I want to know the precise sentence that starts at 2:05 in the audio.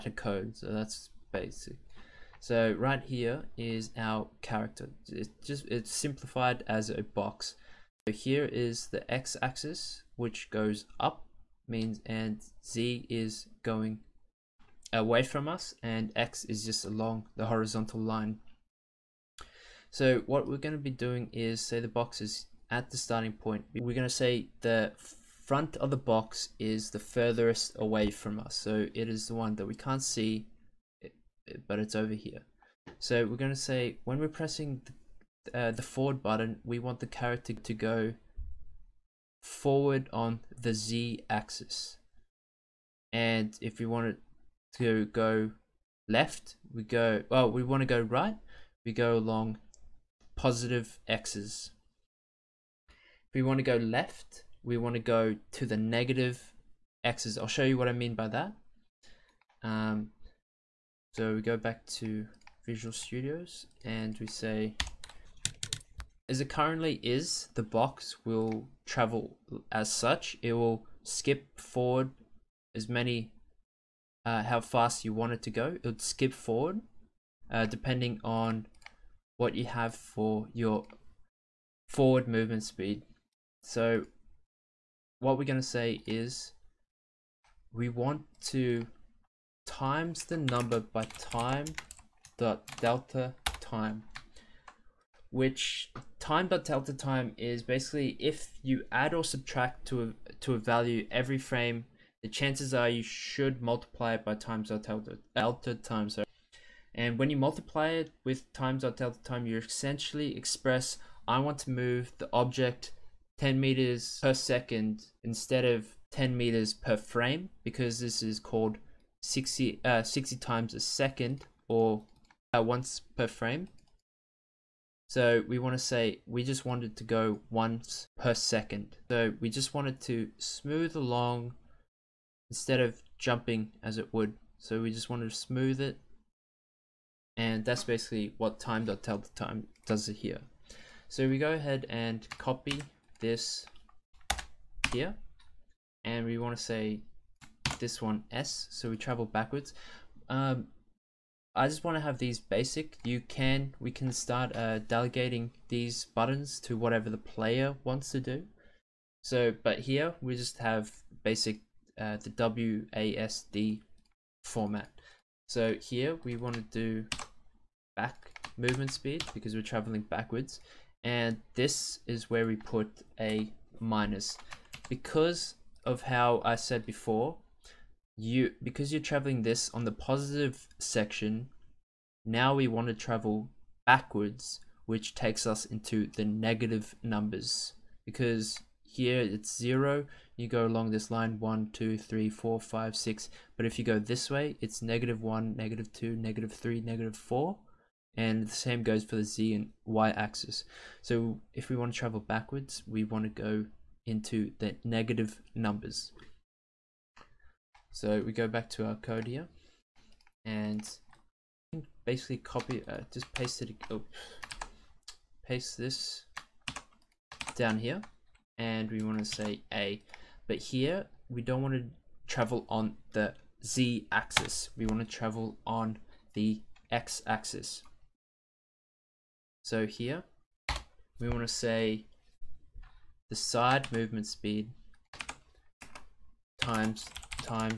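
So we want to say we just wanted to go once per second.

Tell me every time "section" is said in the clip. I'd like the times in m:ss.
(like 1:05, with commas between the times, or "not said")
3:00.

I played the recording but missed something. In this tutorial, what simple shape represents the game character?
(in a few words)
A box.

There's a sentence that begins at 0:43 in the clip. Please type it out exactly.
And if we want it to go left, we go, well, we want to go right, we go along positive x's.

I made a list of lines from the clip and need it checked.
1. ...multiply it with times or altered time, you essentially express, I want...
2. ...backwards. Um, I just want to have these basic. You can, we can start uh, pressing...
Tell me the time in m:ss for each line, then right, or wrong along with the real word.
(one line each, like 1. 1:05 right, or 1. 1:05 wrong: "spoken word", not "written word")
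1. 1:47 right
2. 2:29 wrong: "delegating", not "pressing".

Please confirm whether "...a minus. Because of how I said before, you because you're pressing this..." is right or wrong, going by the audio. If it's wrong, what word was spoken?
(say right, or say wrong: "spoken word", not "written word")
wrong: "traveling", not "pressing".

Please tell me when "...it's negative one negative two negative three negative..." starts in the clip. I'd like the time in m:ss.
3:14.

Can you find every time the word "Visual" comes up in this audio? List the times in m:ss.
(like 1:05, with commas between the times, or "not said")
1:02.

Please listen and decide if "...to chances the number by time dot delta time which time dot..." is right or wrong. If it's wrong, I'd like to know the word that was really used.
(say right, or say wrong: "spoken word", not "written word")
wrong: "times", not "chances".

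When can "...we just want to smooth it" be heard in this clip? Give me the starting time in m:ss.
2:14.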